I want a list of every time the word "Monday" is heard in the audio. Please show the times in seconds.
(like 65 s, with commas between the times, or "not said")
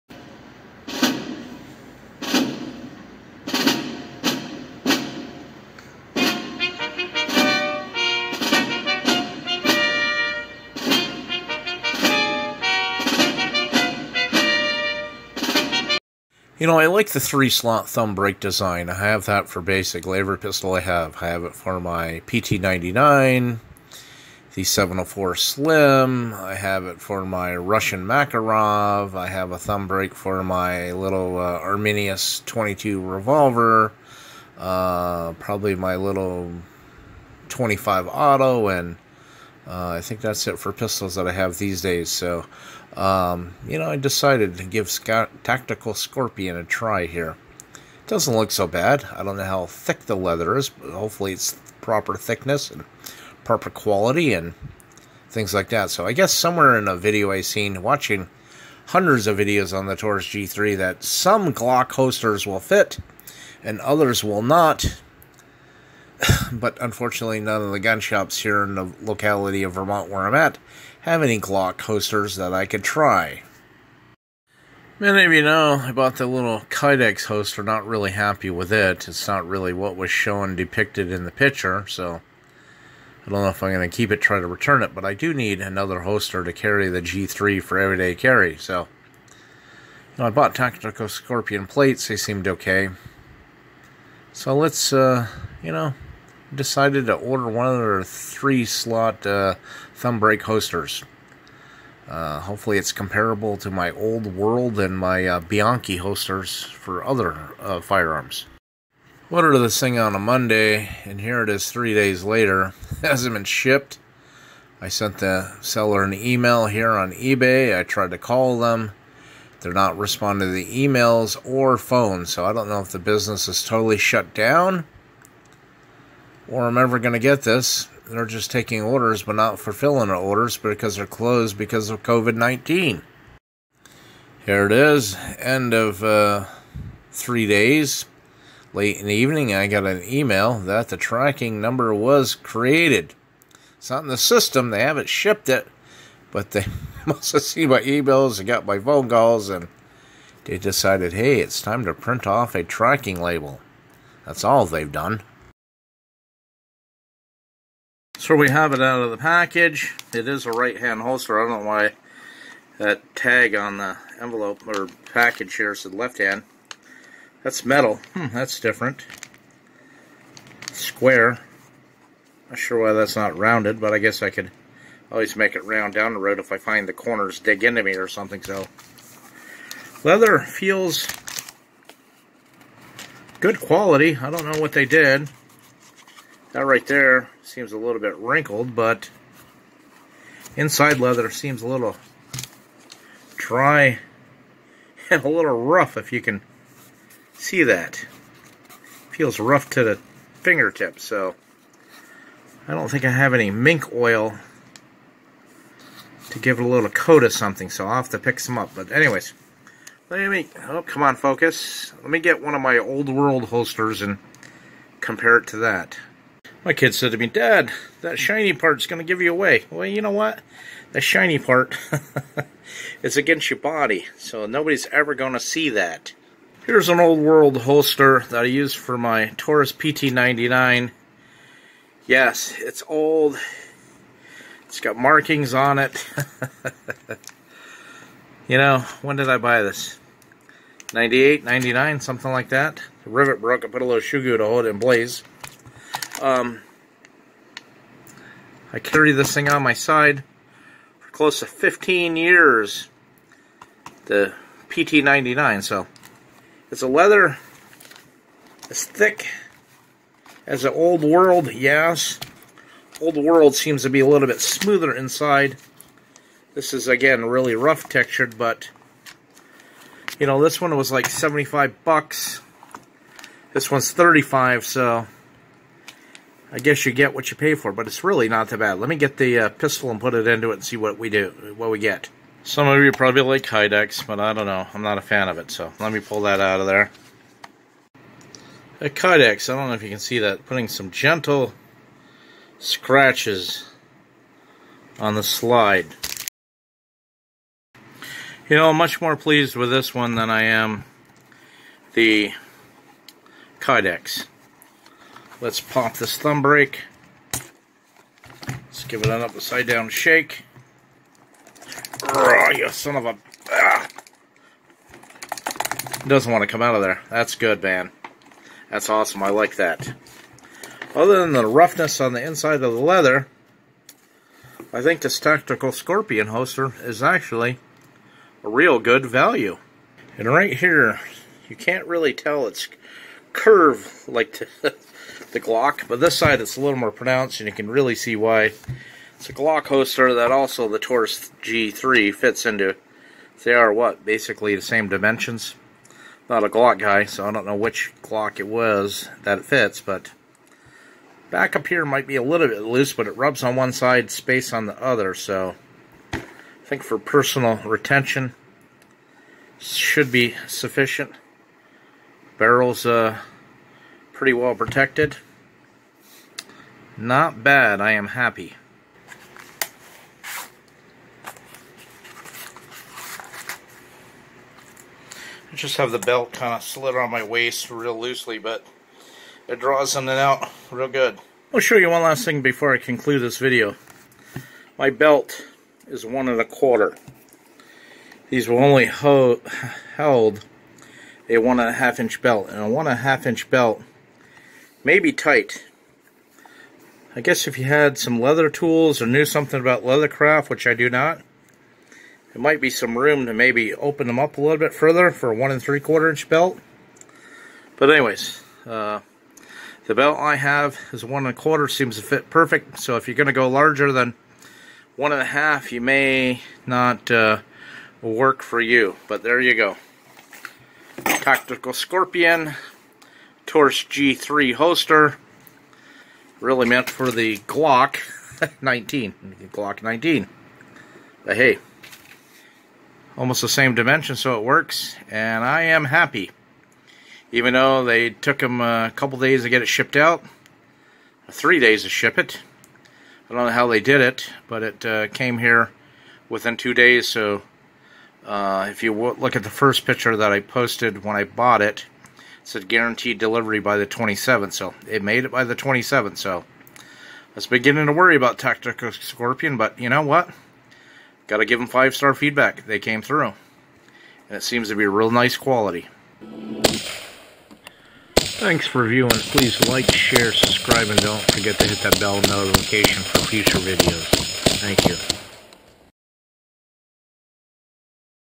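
110 s.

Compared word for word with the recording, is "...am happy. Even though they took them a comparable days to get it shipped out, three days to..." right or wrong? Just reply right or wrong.
wrong.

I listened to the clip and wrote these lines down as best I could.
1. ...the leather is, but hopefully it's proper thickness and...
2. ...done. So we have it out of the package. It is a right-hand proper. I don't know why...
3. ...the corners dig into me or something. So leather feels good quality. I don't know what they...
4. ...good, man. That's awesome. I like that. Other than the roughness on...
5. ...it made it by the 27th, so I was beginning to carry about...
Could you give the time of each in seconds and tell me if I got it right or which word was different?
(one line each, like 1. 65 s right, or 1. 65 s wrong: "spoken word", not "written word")
1. 50 s right
2. 154 s wrong: "holster", not "proper"
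3. 176 s right
4. 317 s right
5. 454 s wrong: "worry", not "carry".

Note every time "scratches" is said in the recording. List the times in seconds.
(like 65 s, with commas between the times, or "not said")
292 s.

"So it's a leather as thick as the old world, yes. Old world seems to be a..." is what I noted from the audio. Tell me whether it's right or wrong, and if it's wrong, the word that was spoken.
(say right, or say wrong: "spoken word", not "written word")
right.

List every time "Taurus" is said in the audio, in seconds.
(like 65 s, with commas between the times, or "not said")
59 s, 229 s, 340 s, 423 s.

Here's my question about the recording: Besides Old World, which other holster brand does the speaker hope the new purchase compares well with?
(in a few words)
Bianchi.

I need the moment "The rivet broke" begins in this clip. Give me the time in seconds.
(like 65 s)
243 s.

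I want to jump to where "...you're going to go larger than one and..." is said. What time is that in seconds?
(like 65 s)
413 s.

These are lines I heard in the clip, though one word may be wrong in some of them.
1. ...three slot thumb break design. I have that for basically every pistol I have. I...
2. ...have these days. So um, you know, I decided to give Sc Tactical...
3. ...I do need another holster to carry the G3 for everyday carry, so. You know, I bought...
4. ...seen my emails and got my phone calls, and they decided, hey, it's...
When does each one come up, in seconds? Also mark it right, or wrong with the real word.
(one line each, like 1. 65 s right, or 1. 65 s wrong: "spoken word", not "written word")
1. 17 s right
2. 41 s right
3. 85 s right
4. 147 s right.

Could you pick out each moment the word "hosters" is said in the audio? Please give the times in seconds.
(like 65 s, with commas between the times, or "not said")
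100 s, 105 s.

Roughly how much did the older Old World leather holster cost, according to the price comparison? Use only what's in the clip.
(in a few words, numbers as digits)
$75.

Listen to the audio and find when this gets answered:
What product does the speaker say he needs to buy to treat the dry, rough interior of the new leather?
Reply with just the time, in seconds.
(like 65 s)
203 s.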